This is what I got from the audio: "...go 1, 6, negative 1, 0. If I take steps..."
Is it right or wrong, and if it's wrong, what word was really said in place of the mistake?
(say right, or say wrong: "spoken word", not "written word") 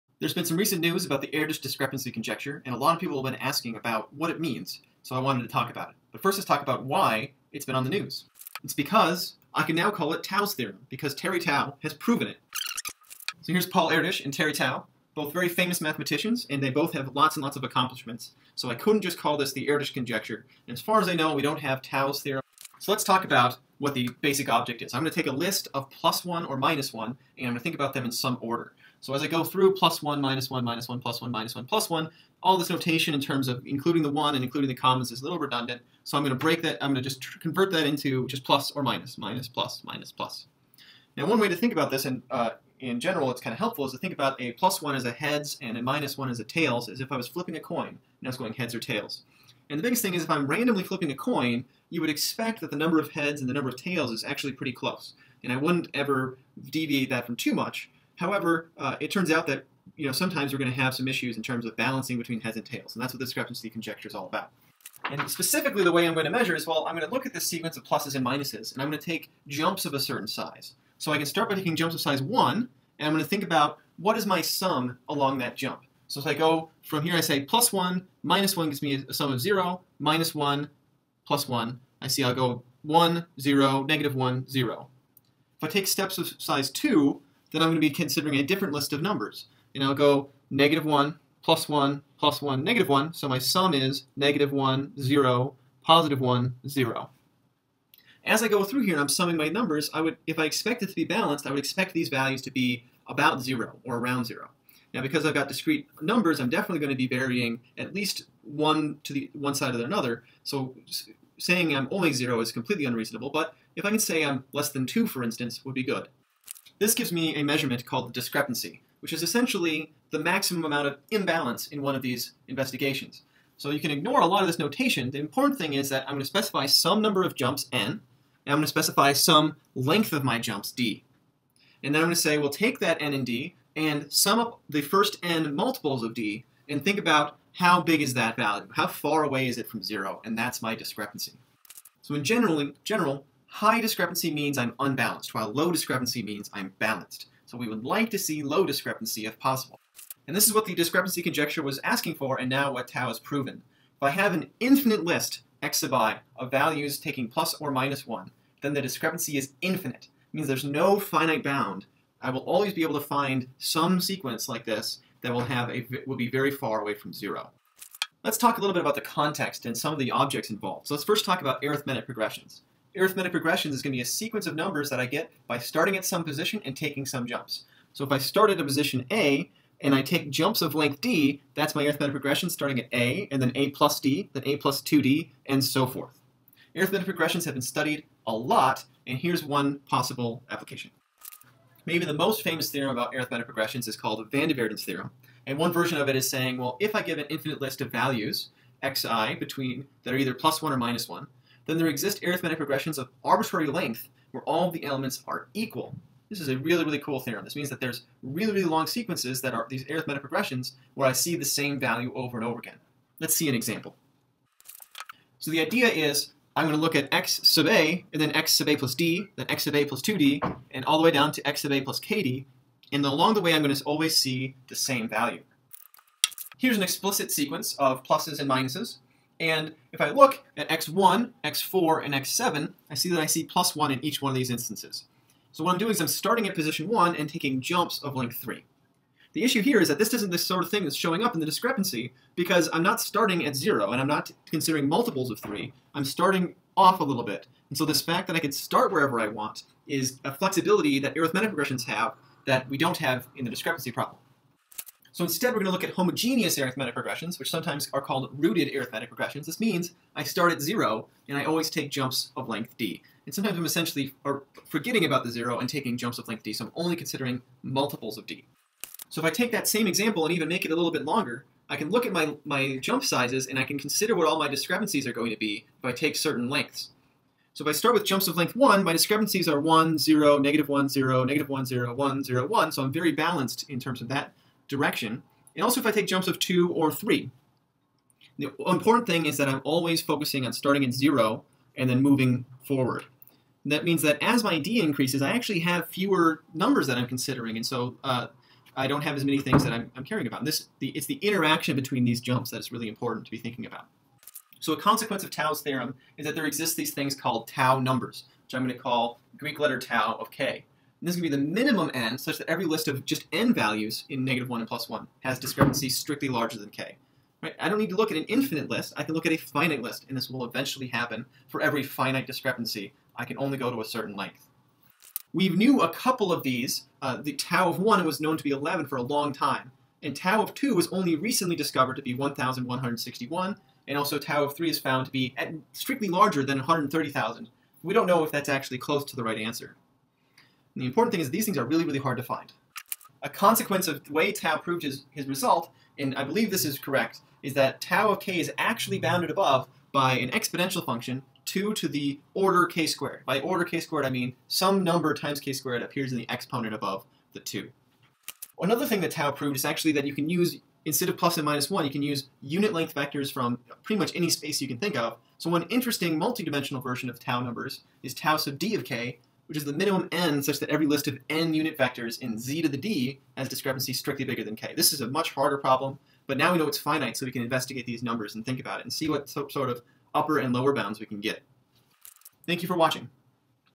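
wrong: "0", not "6".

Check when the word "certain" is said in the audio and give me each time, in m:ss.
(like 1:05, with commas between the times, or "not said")
1:09, 4:36, 5:23.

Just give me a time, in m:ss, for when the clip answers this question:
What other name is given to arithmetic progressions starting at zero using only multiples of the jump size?
4:18.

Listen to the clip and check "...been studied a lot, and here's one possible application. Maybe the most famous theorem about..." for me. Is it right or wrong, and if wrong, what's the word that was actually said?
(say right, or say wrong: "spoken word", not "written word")
right.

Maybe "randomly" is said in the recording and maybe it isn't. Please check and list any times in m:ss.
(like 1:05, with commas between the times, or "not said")
0:50.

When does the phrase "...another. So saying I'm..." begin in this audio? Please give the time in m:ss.
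1:49.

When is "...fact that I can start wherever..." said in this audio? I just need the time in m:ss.
4:08.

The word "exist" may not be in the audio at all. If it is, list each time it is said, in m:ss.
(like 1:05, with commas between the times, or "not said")
3:21, 5:06.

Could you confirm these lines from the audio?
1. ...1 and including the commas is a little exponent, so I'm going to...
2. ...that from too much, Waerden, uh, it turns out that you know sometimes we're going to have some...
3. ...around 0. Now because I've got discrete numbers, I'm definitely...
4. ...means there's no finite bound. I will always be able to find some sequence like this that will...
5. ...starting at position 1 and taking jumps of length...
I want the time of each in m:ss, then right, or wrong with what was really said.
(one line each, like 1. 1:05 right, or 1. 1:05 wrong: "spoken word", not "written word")
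1. 0:34 wrong: "redundant", not "exponent"
2. 0:57 wrong: "However", not "Waerden"
3. 1:43 right
4. 2:40 right
5. 3:56 right.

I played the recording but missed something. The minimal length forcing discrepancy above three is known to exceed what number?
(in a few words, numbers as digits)
130,000.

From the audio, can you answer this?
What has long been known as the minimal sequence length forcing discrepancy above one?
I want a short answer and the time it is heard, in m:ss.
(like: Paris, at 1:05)
11, at 5:28.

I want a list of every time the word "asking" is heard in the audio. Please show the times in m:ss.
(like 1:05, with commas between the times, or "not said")
0:03, 2:31.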